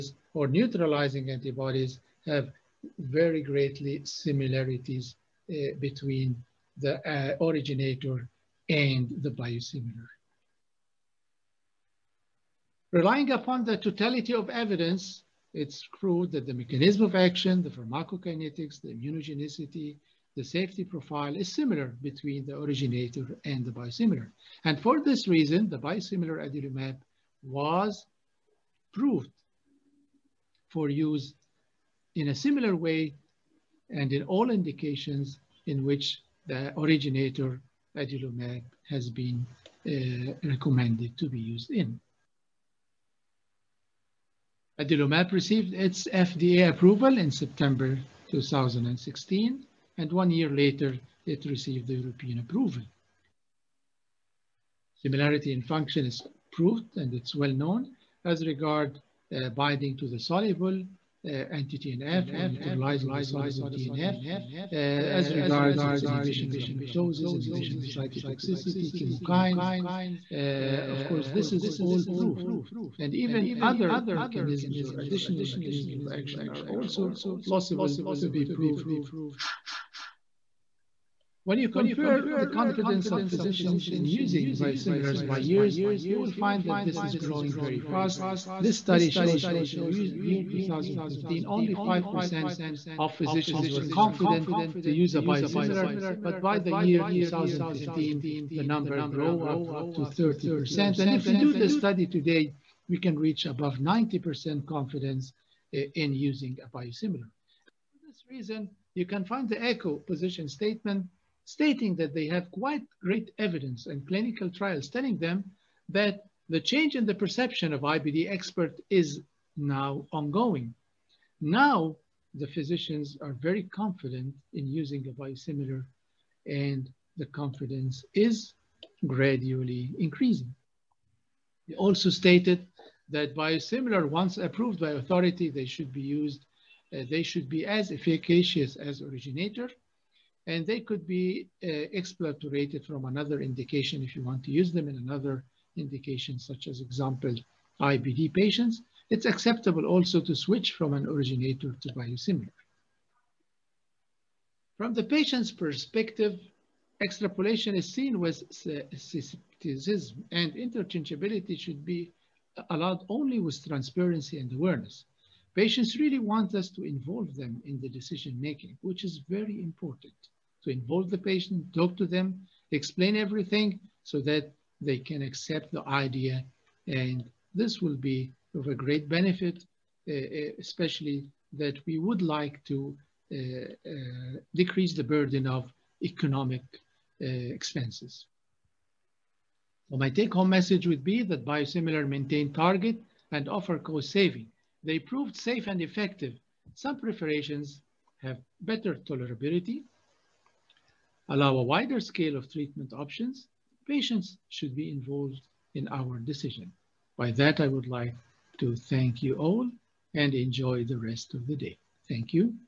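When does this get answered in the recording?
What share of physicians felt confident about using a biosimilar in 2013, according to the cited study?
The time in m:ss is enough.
1:31.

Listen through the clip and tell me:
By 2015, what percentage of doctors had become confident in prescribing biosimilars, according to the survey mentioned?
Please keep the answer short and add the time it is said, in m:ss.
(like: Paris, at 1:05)
30%, at 1:40.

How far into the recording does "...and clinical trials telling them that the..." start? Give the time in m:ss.
1:53.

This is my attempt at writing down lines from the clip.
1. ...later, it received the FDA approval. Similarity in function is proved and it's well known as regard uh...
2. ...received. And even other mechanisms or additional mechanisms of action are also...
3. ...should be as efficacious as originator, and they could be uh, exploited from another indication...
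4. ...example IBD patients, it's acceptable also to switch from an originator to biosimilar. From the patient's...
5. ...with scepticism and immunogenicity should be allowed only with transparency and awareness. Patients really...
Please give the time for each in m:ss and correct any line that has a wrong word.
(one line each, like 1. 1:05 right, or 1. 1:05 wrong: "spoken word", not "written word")
1. 0:50 wrong: "European", not "FDA"
2. 1:12 wrong: "proved", not "received"
3. 2:17 right
4. 2:26 right
5. 2:38 wrong: "interchangeability", not "immunogenicity".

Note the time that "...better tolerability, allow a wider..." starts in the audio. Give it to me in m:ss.
3:18.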